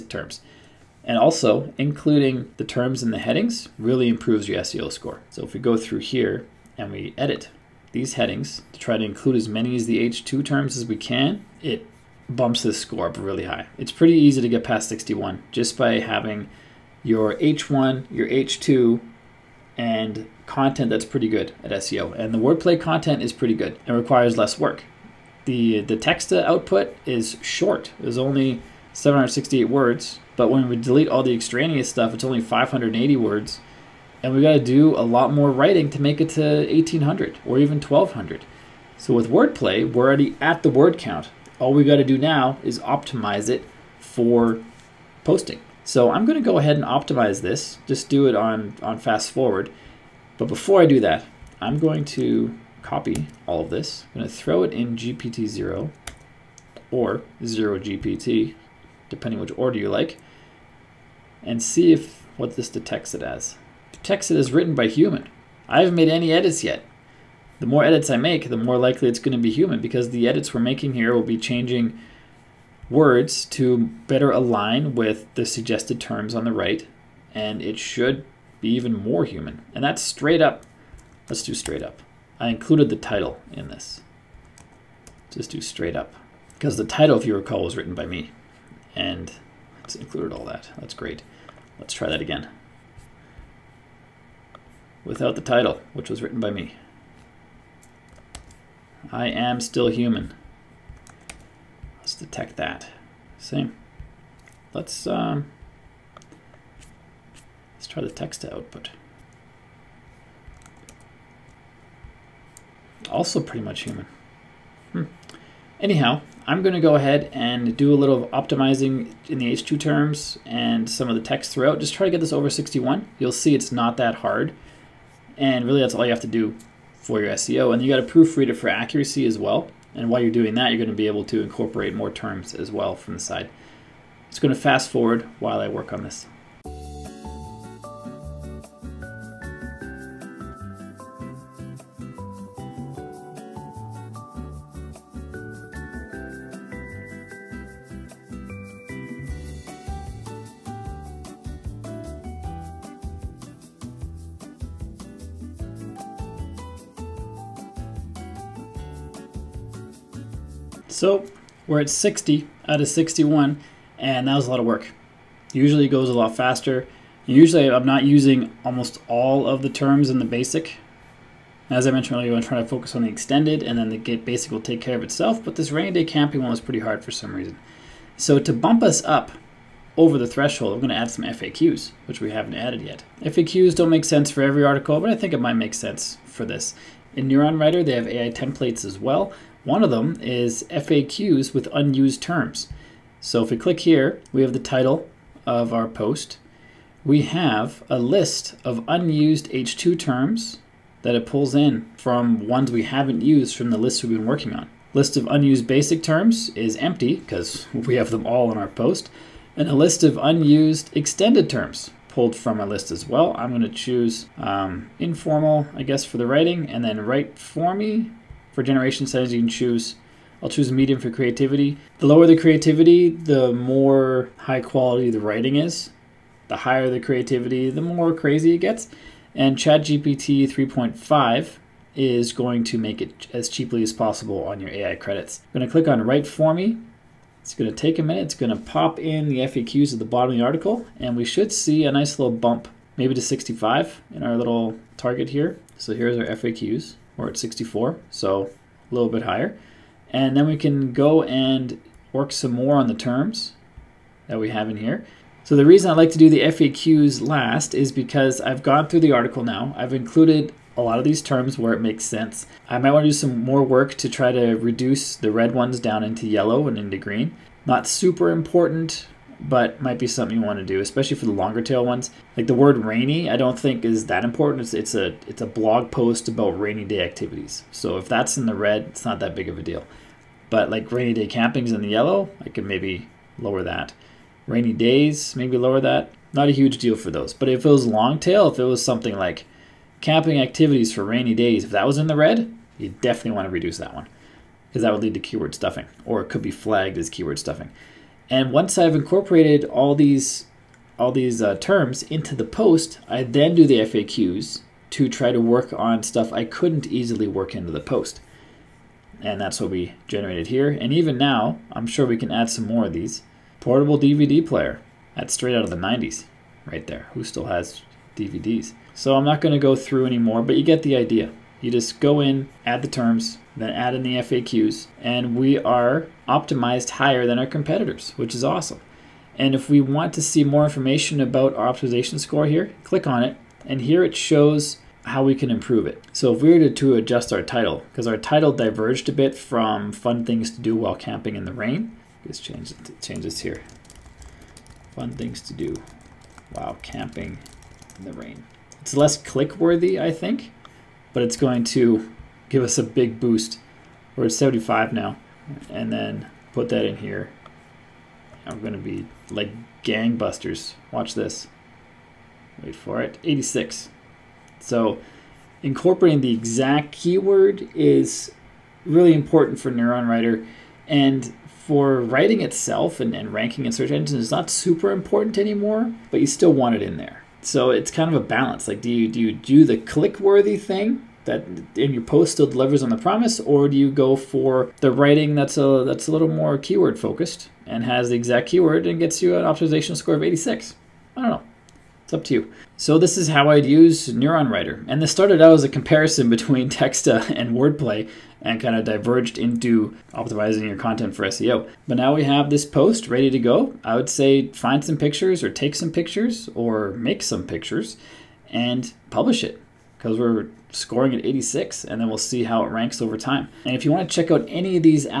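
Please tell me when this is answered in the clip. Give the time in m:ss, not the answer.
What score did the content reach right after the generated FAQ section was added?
4:07.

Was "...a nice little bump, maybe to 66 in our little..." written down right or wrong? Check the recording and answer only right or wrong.
wrong.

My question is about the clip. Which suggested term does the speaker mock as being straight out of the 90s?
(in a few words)
Portable DVD player.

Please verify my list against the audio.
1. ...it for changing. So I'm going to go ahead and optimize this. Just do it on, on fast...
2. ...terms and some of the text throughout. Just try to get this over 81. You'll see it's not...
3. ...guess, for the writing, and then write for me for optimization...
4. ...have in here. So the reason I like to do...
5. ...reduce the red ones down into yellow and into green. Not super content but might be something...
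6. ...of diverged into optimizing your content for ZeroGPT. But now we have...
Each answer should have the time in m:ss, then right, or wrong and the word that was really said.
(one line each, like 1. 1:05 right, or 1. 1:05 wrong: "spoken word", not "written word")
1. 0:43 wrong: "posting", not "changing"
2. 1:59 wrong: "61", not "81"
3. 3:35 wrong: "generation", not "optimization"
4. 4:14 right
5. 4:24 wrong: "important", not "content"
6. 6:38 wrong: "SEO", not "ZeroGPT".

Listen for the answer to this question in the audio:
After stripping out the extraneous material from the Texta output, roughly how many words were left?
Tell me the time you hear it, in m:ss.
0:32.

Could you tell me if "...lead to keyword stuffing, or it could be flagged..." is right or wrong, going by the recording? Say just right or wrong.
right.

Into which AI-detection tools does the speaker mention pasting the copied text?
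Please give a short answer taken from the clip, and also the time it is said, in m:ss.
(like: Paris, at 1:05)
GPTZero or ZeroGPT, at 0:54.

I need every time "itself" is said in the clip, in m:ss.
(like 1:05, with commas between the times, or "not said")
2:55, 6:12.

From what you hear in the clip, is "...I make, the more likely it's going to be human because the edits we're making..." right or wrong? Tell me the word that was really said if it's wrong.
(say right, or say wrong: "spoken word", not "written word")
right.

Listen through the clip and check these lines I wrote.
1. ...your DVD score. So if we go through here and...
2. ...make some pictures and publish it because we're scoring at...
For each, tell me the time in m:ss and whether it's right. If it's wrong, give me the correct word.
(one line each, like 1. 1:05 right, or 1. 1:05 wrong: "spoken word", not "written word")
1. 0:04 wrong: "SEO", not "DVD"
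2. 6:46 right.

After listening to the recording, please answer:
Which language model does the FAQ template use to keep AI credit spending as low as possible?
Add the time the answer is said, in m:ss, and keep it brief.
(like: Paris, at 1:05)
ChatGPT 3.5, at 3:49.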